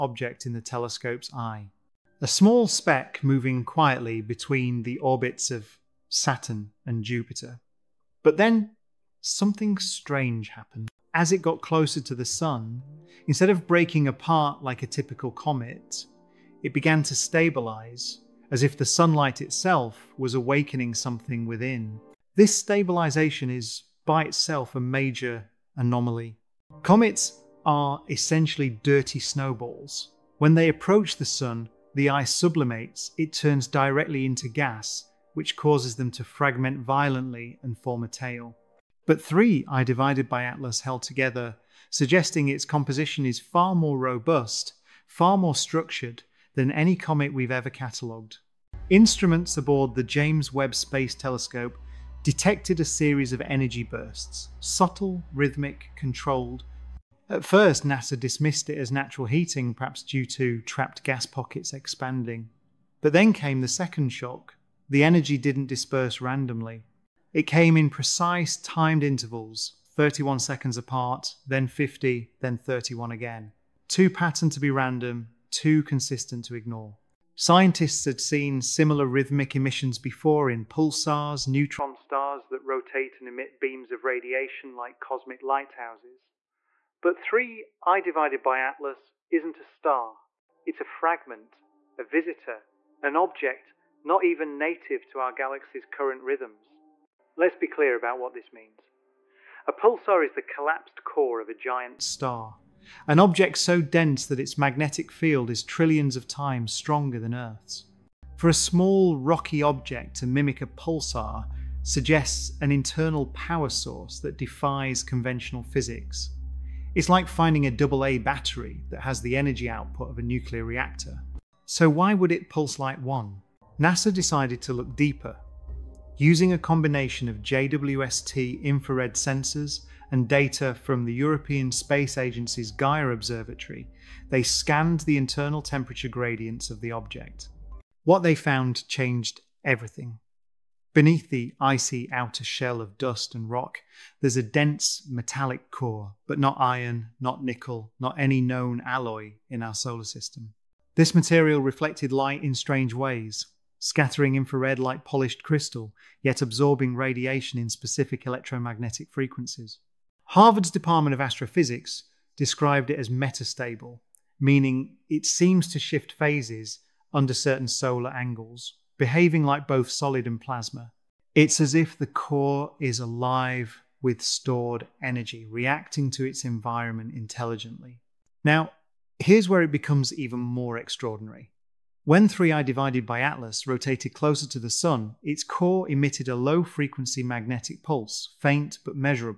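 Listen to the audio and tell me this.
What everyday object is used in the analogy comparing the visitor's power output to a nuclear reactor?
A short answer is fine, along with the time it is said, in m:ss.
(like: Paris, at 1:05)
AA battery, at 1:57.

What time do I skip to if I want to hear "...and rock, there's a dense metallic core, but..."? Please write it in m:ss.
2:23.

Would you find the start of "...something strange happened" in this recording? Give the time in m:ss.
0:09.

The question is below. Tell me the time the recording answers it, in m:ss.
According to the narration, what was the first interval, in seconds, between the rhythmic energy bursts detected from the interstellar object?
1:09.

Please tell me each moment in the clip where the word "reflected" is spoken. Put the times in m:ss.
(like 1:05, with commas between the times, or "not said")
2:31.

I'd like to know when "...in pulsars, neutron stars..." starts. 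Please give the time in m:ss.
1:20.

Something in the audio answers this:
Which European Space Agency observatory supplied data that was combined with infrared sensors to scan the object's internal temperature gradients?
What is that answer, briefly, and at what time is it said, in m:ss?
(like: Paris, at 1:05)
Gaia, at 2:12.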